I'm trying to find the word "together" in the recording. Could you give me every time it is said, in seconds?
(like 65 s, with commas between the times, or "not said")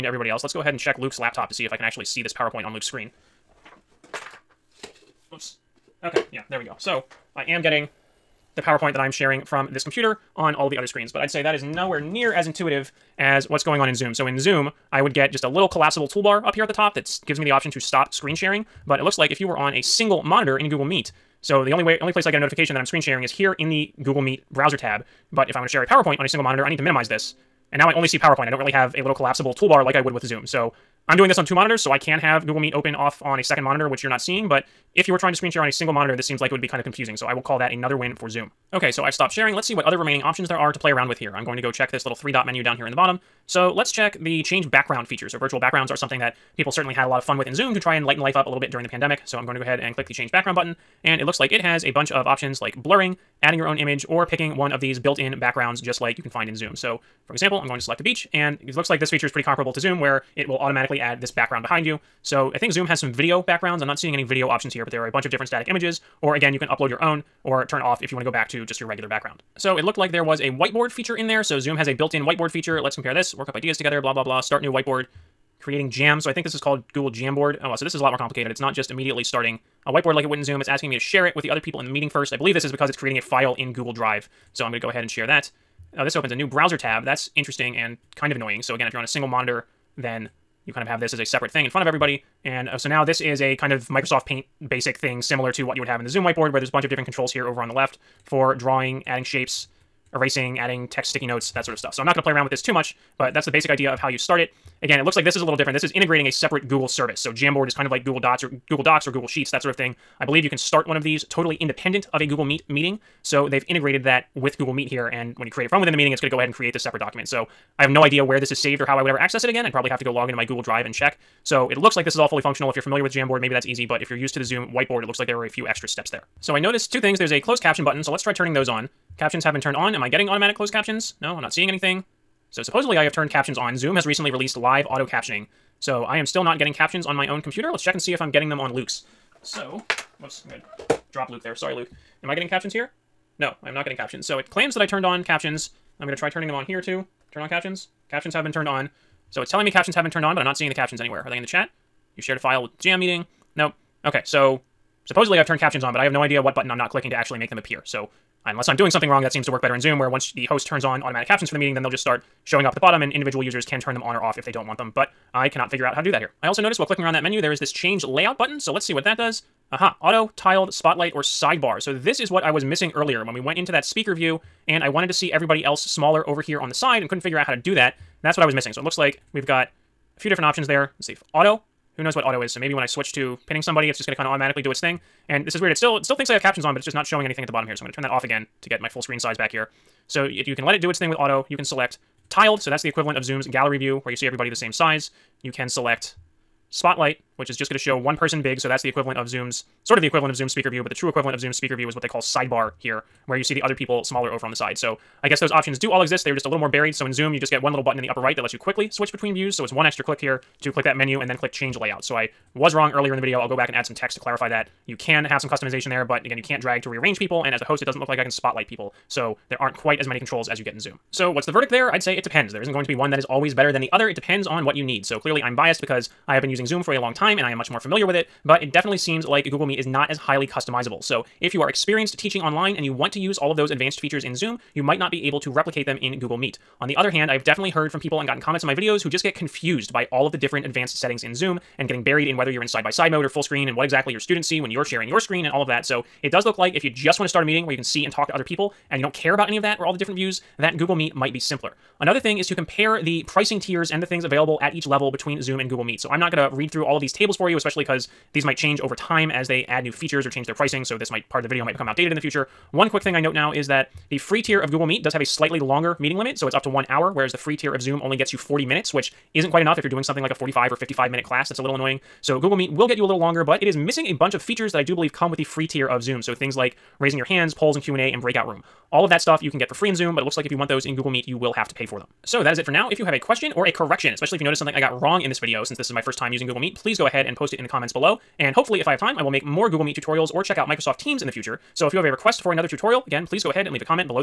73 s.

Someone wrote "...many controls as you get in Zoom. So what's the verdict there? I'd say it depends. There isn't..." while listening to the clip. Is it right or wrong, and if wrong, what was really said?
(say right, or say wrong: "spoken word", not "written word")
right.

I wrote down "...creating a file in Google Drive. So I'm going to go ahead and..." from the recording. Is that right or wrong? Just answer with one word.
right.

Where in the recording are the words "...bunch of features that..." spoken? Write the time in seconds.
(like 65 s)
274 s.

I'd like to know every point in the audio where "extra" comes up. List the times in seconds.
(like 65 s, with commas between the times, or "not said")
125 s, 209 s.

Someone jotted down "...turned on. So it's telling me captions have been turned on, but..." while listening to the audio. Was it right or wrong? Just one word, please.
right.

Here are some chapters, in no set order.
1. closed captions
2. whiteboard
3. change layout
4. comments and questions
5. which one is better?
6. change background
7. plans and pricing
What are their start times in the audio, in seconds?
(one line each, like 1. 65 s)
1. 125 s
2. 69 s
3. 165 s
4. 281 s
5. 220 s
6. 38 s
7. 251 s.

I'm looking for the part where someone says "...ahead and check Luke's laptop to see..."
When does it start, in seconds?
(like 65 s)
0 s.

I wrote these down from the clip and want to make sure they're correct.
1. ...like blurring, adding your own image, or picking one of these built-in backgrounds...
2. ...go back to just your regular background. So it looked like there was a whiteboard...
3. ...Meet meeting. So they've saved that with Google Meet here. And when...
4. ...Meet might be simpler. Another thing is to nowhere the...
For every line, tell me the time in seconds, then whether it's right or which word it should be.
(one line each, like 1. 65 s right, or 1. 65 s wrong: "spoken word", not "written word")
1. 52 s right
2. 68 s right
3. 112 s wrong: "integrated", not "saved"
4. 250 s wrong: "compare", not "nowhere".